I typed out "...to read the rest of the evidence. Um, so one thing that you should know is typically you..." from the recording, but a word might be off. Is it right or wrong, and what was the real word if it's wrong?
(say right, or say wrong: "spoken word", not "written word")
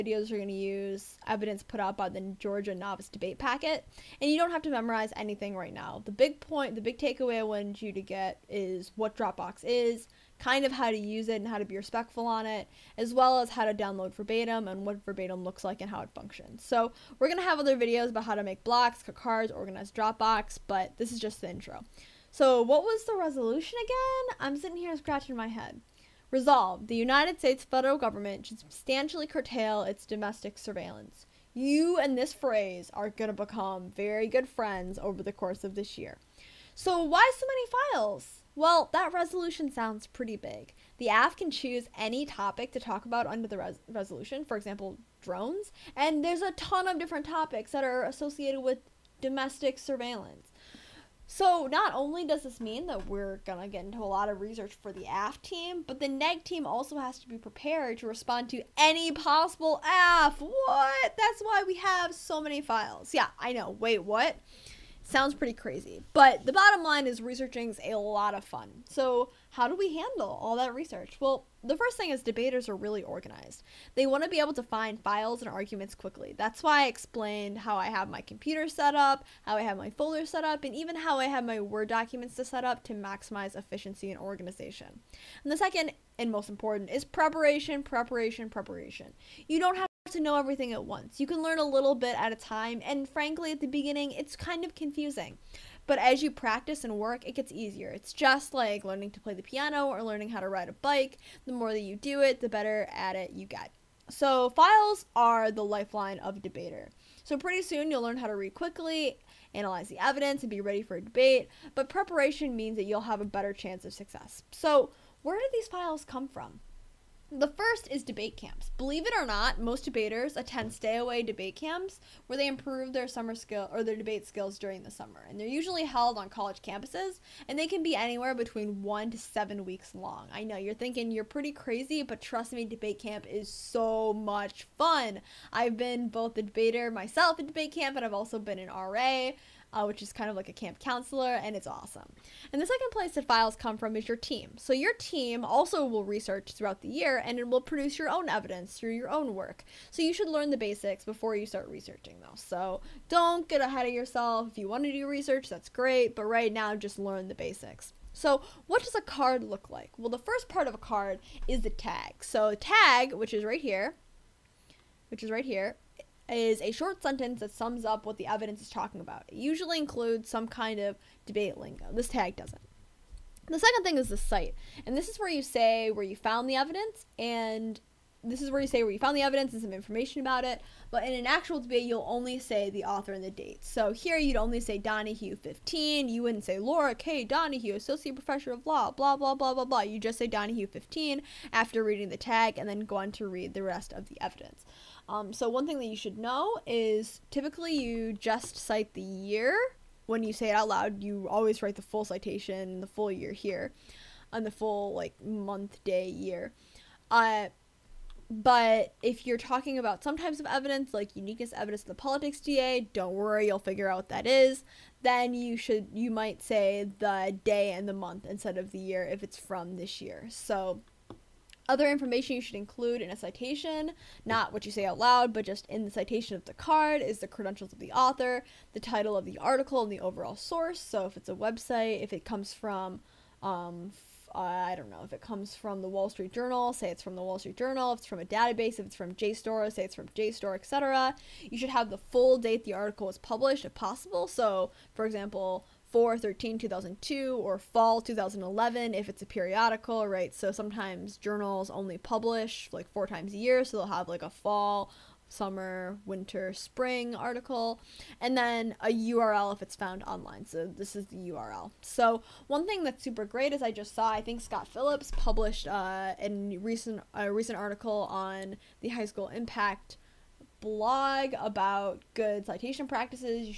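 right.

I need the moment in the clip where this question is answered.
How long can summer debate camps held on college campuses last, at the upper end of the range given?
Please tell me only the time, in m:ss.
2:09.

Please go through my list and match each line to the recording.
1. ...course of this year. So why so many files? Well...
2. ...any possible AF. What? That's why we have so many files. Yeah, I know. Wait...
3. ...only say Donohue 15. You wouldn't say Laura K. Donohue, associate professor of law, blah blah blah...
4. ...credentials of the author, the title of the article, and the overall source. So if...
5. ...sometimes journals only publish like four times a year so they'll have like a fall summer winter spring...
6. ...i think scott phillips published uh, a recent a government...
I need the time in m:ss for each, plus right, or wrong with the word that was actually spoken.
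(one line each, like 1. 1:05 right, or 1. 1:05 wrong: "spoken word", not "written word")
1. 0:35 right
2. 0:58 right
3. 3:04 right
4. 3:47 right
5. 4:10 right
6. 4:24 wrong: "recent", not "government".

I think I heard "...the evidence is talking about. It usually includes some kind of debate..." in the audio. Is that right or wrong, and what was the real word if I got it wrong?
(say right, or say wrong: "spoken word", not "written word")
right.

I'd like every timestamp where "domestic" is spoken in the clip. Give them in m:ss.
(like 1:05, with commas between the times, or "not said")
0:30, 0:49.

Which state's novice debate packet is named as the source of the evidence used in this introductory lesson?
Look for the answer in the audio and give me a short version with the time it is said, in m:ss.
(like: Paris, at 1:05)
Georgia, at 0:02.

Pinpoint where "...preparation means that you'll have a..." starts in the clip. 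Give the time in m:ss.
1:51.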